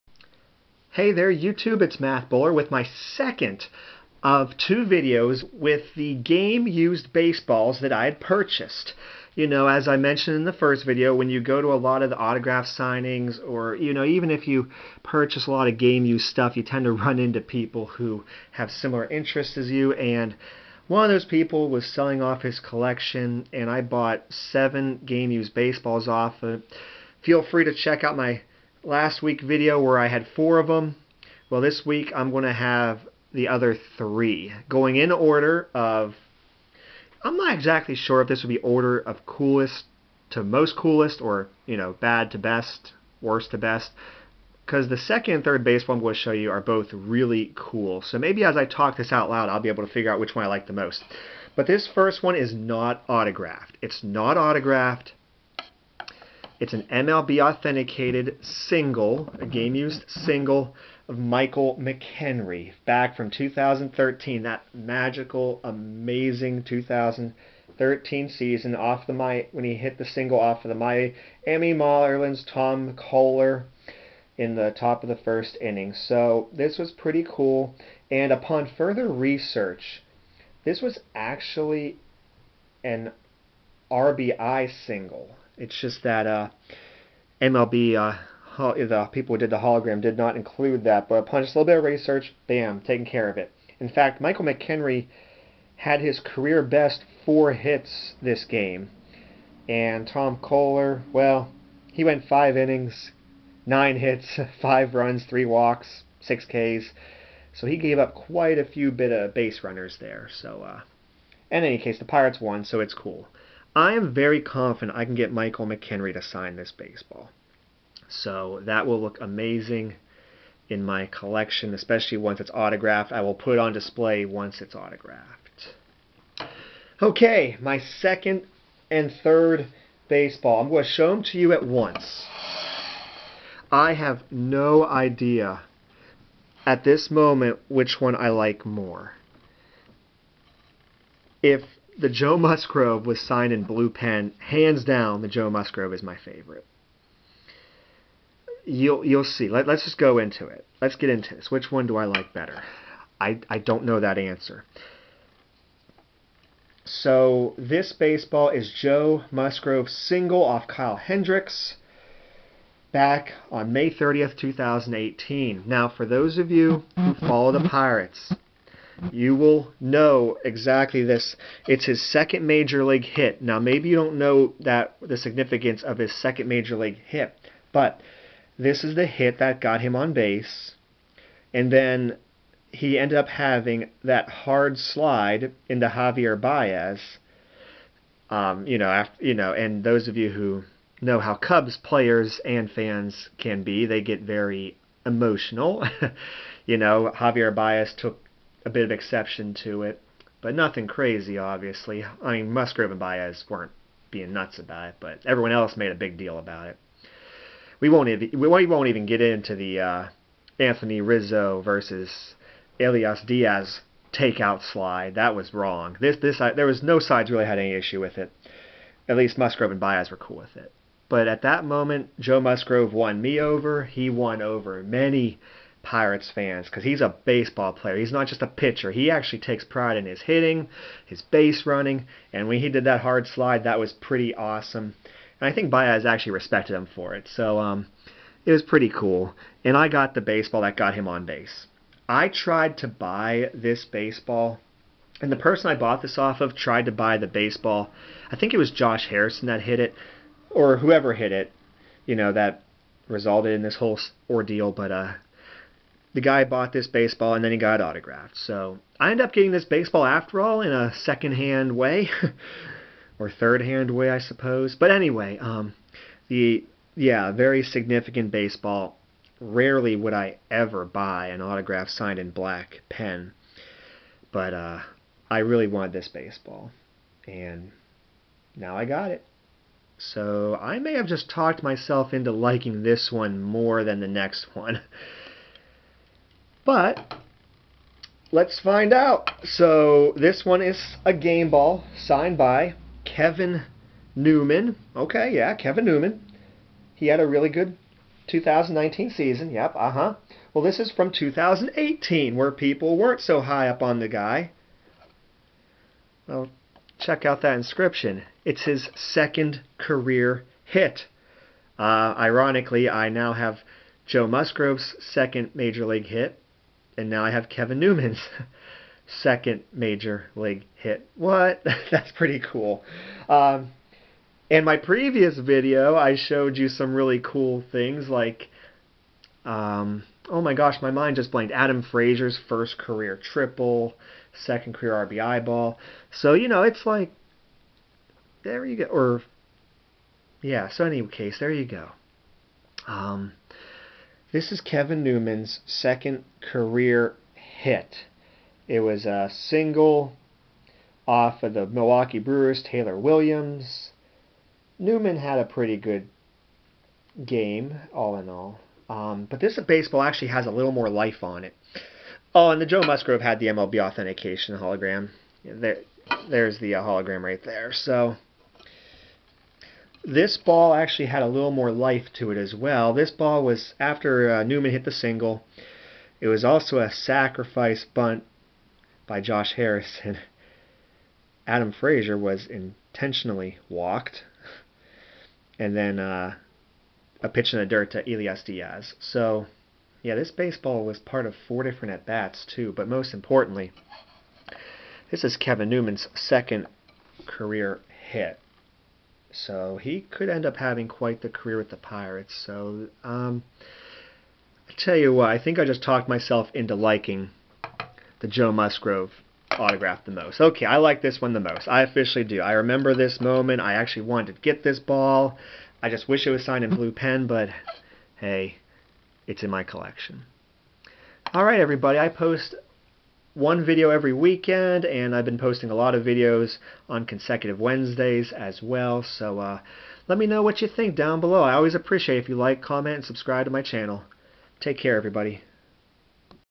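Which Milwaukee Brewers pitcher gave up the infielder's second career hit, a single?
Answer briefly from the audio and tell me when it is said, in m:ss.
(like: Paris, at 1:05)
Taylor Williams, at 5:52.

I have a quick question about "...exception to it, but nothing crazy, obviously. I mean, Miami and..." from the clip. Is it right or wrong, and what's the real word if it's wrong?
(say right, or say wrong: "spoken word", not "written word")
wrong: "Musgrove", not "Miami".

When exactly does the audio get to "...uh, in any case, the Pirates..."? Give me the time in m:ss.
1:50.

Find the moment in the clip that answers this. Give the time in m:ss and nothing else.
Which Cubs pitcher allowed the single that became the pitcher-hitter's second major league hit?
2:40.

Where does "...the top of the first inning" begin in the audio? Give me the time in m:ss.
1:14.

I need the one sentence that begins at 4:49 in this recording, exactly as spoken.
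So this one is a game ball signed by Kevin Newman.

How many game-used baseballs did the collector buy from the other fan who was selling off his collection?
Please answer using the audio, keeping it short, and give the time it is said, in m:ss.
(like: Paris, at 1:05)
7, at 0:24.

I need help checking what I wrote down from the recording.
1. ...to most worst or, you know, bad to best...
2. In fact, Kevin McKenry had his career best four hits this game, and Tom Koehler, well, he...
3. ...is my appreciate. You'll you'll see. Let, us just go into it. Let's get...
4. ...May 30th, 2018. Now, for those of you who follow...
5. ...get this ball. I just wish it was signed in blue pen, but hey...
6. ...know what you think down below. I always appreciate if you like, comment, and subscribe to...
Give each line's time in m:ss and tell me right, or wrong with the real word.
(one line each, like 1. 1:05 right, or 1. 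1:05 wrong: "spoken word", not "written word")
1. 0:40 wrong: "coolest", not "worst"
2. 1:33 wrong: "Michael", not "Kevin"
3. 2:25 wrong: "favorite", not "appreciate"
4. 2:43 right
5. 6:54 right
6. 7:10 right.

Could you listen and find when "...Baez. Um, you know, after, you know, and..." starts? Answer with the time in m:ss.
3:06.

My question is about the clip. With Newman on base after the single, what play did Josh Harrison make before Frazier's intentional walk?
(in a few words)
sacrifice bunt.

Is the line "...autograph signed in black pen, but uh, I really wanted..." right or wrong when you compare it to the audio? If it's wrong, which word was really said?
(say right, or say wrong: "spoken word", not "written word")
right.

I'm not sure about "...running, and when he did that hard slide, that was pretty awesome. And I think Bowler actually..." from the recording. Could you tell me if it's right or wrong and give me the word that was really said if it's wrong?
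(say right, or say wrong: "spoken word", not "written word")
wrong: "Baez", not "Bowler".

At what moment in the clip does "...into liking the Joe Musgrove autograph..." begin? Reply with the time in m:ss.
6:46.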